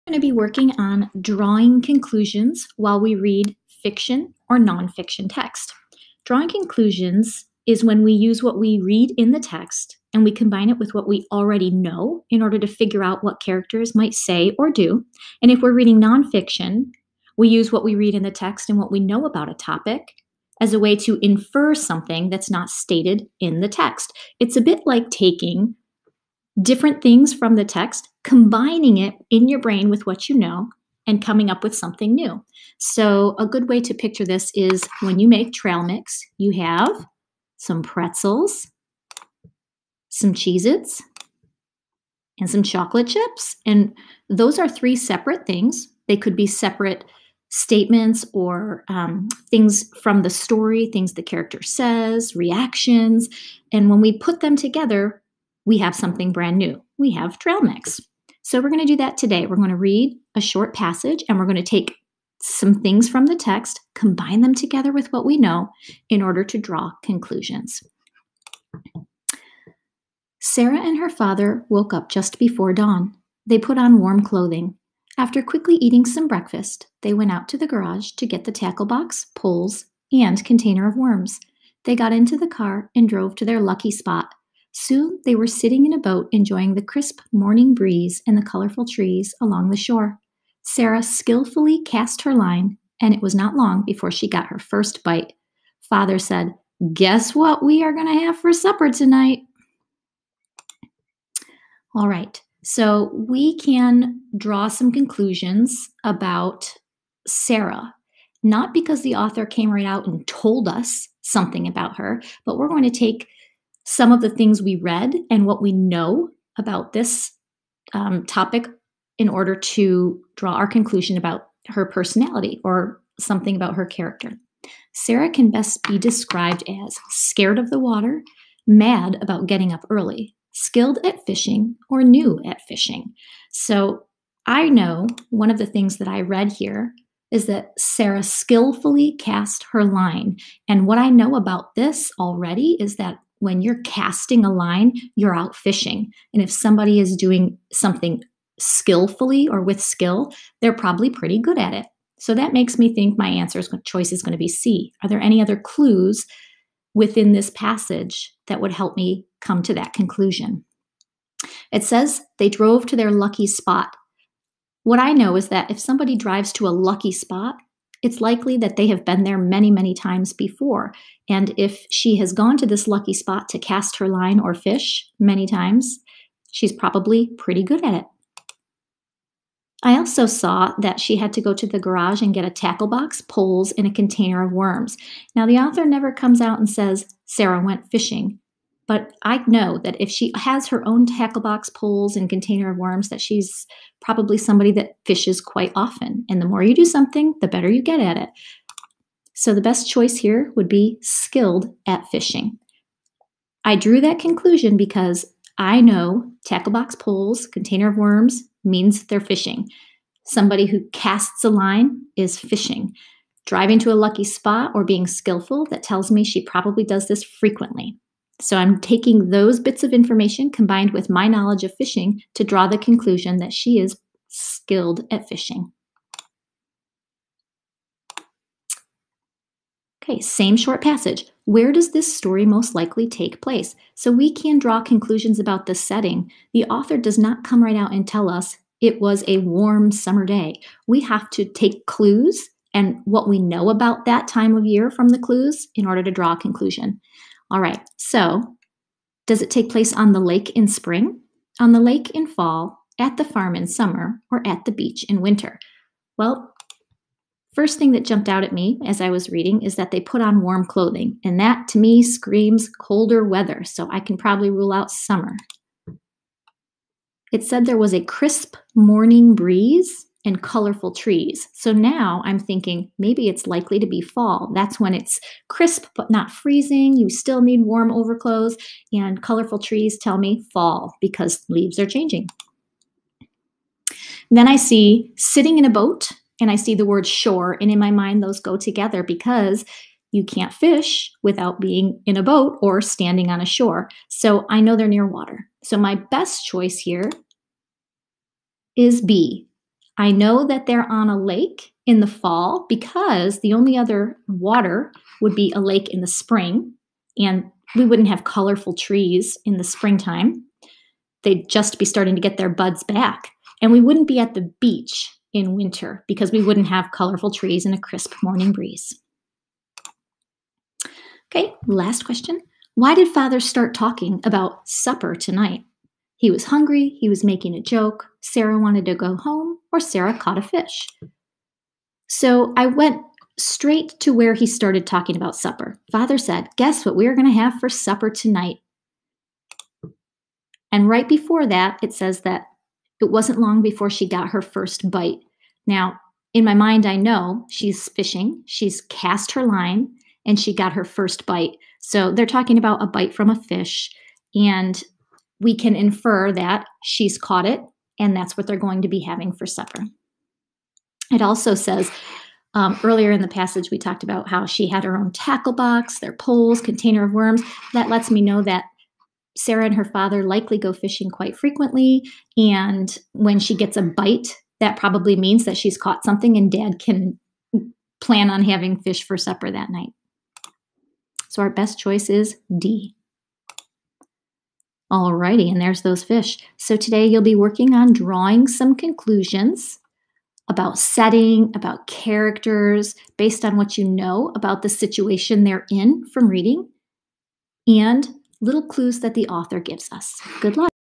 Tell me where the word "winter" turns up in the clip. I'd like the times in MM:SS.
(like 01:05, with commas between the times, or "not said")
04:15, 05:15.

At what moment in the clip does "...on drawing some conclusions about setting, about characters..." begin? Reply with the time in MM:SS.
06:27.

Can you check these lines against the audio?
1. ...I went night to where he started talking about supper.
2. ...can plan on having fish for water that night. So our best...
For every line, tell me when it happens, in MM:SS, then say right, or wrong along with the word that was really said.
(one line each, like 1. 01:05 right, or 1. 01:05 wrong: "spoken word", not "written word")
1. 05:32 wrong: "straight", not "night"
2. 06:16 wrong: "supper", not "water".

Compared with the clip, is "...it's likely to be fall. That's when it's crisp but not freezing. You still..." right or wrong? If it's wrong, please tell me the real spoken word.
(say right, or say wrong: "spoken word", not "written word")
right.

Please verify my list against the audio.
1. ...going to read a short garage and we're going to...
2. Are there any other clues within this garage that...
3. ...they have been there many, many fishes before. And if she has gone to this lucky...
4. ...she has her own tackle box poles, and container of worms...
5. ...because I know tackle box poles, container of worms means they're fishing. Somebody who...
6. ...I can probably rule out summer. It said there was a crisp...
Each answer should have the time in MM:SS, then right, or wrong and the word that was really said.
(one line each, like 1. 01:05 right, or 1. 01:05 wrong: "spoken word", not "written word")
1. 00:59 wrong: "passage", not "garage"
2. 02:35 wrong: "passage", not "garage"
3. 02:48 wrong: "times", not "fishes"
4. 03:10 right
5. 03:24 right
6. 04:23 right.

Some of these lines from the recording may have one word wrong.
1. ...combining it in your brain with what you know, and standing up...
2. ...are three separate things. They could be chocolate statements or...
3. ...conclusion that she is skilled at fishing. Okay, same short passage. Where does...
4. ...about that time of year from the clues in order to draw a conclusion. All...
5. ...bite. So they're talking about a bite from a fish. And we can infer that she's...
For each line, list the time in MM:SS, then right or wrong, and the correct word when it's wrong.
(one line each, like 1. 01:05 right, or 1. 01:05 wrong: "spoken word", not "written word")
1. 00:28 wrong: "coming", not "standing"
2. 00:44 wrong: "separate", not "chocolate"
3. 03:42 right
4. 04:03 right
5. 05:51 right.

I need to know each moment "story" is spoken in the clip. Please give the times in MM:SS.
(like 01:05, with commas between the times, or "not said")
00:50, 03:52.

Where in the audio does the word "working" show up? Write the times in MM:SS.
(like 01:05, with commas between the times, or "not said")
00:00, 06:27.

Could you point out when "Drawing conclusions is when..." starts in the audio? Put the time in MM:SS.
00:06.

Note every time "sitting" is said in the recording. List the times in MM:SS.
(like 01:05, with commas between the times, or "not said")
01:25, 04:45.